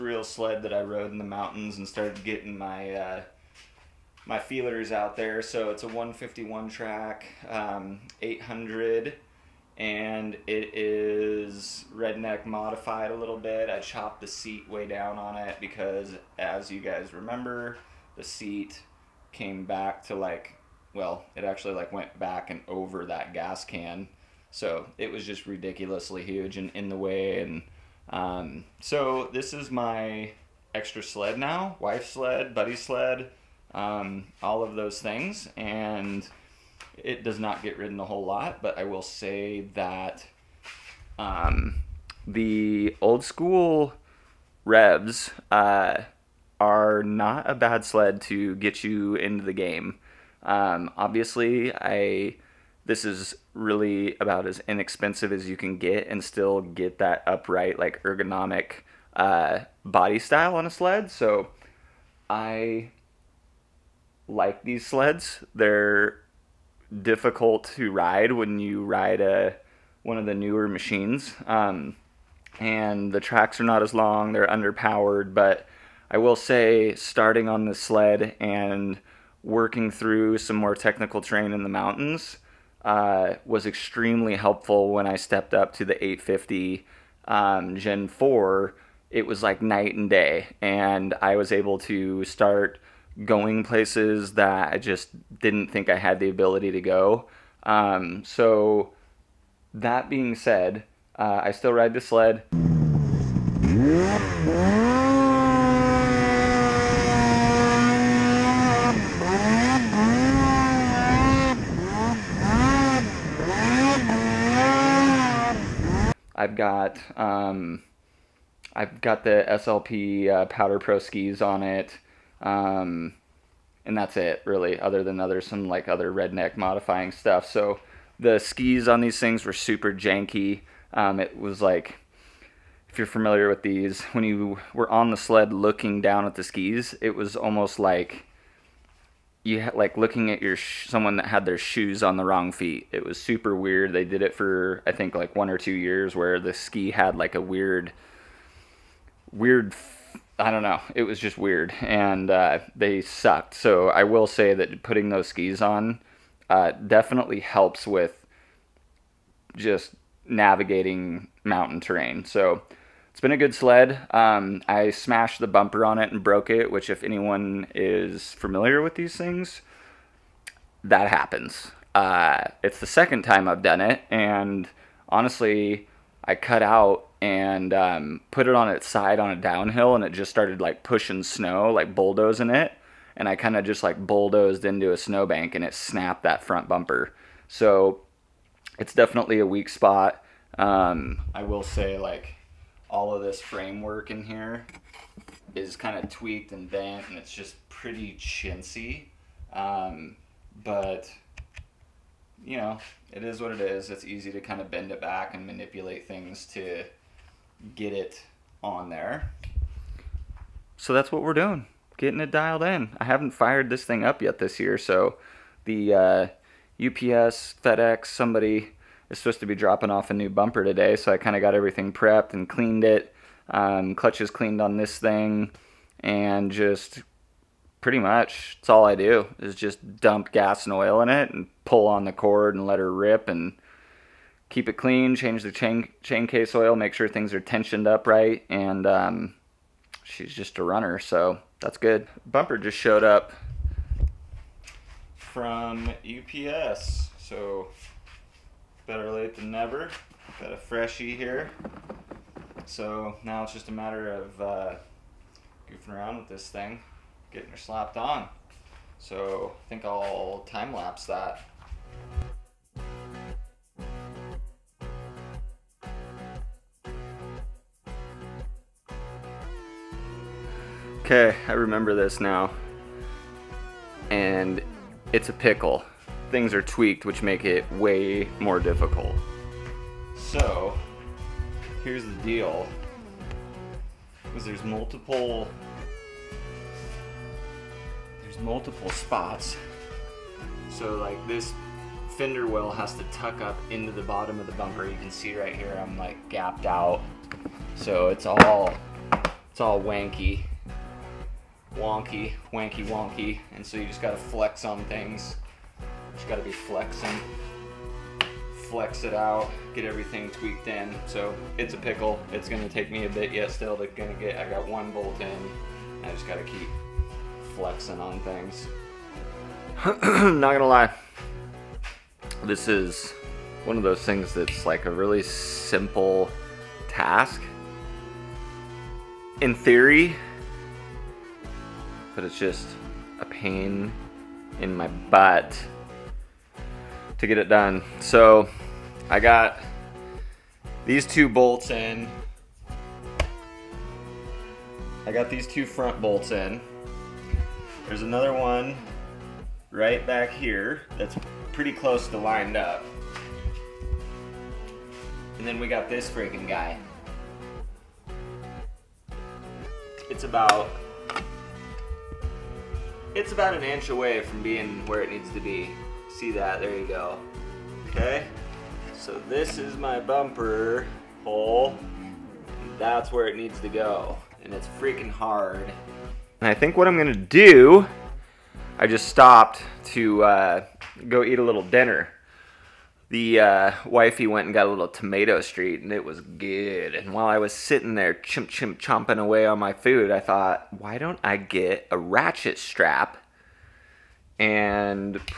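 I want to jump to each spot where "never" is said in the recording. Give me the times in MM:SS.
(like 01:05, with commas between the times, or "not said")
04:09.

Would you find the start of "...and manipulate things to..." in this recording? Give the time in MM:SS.
03:25.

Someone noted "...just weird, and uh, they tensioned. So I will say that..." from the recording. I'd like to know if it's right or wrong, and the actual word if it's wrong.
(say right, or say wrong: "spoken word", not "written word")
wrong: "sucked", not "tensioned".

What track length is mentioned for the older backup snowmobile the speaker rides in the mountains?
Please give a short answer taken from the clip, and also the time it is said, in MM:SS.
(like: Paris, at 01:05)
151, at 00:05.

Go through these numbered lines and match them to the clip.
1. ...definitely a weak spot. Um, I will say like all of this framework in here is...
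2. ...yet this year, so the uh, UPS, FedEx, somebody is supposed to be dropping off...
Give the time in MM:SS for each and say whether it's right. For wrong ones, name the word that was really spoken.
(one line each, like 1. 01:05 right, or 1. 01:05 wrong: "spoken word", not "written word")
1. 03:08 right
2. 03:34 right.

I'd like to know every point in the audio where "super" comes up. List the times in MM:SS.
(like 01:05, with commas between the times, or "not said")
02:09, 02:23.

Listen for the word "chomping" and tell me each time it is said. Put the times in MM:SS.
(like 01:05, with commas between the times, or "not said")
06:28.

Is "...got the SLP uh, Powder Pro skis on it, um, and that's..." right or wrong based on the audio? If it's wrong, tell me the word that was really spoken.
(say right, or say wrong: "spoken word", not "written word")
right.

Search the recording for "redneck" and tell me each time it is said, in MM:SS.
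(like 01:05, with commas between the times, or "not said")
00:11, 02:06.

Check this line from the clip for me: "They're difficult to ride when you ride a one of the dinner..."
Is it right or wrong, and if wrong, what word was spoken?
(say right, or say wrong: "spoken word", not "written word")
wrong: "newer", not "dinner".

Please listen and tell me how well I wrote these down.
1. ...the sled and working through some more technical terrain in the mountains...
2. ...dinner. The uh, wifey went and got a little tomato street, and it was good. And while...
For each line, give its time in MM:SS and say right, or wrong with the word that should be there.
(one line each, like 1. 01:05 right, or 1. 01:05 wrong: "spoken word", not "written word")
1. 01:17 right
2. 06:21 right.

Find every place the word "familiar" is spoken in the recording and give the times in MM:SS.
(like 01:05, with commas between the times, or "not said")
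02:13, 02:48.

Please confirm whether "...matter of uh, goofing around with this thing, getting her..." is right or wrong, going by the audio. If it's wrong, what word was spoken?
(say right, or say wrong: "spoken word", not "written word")
right.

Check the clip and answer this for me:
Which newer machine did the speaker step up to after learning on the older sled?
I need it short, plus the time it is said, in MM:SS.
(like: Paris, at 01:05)
850 Gen 4, at 01:26.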